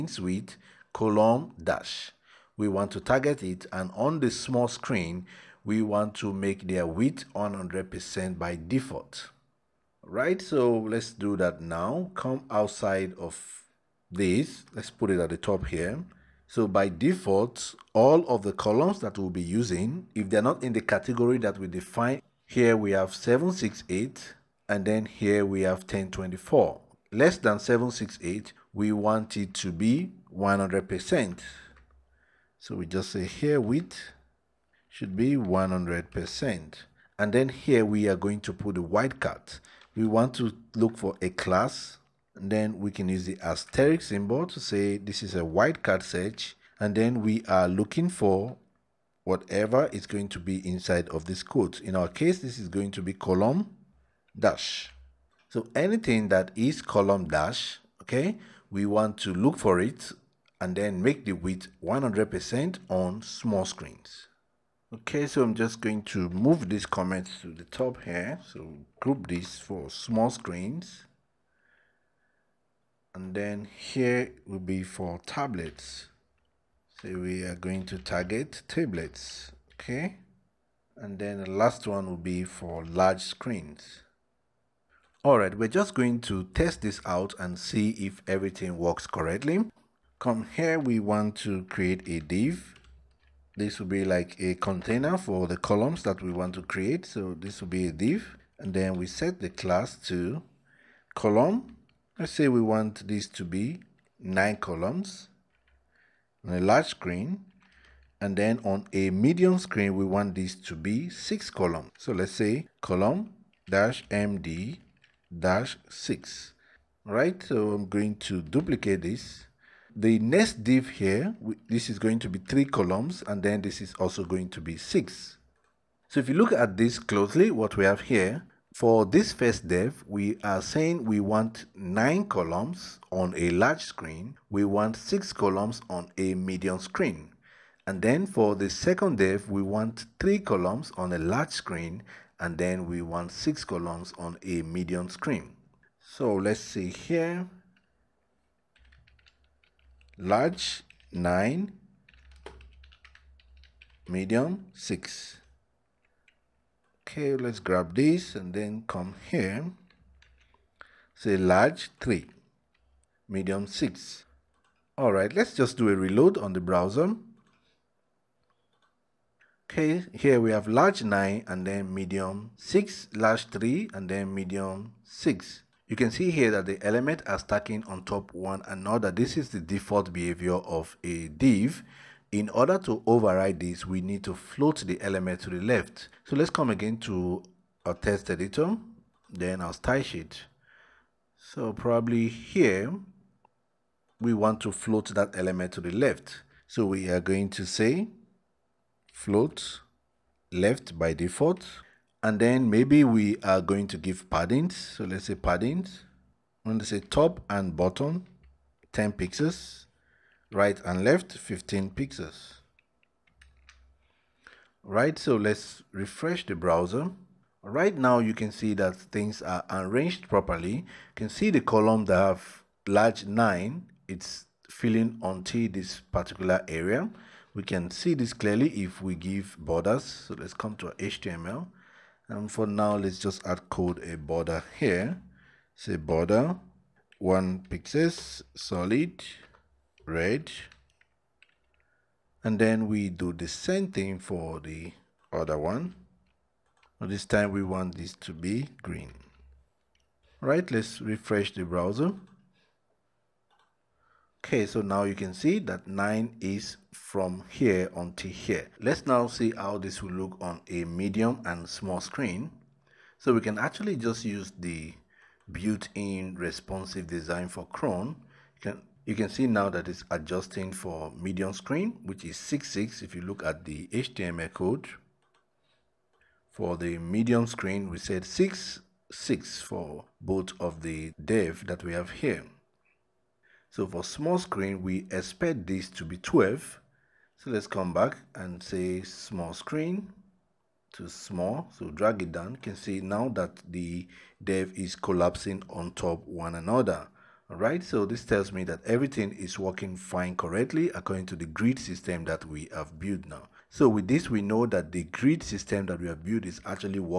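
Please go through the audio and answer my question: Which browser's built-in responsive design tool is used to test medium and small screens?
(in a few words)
Chrome.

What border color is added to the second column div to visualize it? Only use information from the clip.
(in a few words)
green.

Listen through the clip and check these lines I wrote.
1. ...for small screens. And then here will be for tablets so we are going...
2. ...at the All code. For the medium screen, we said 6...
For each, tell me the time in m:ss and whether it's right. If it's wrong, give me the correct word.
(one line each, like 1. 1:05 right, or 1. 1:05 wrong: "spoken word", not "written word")
1. 1:09 right
2. 4:33 wrong: "HTML", not "All".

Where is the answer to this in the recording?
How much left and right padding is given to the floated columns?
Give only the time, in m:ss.
3:31.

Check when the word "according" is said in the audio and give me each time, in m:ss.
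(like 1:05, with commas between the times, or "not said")
5:00.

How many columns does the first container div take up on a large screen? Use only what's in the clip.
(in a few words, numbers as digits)
9.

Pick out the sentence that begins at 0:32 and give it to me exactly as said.
So we just say here width should be 100%.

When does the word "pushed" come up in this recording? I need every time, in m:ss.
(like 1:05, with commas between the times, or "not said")
not said.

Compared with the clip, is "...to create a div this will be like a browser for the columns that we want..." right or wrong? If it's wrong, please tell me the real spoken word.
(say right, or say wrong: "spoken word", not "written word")
wrong: "container", not "browser".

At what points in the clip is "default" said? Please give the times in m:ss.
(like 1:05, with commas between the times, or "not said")
0:08, 0:16, 2:59, 3:21.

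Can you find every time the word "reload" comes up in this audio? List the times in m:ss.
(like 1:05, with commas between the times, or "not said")
2:45.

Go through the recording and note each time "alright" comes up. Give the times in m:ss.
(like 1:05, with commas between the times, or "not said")
1:25, 4:57.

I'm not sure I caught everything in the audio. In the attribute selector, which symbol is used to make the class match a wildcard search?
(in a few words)
asterisk.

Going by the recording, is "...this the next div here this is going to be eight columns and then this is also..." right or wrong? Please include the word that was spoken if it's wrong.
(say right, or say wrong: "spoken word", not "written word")
wrong: "three", not "eight".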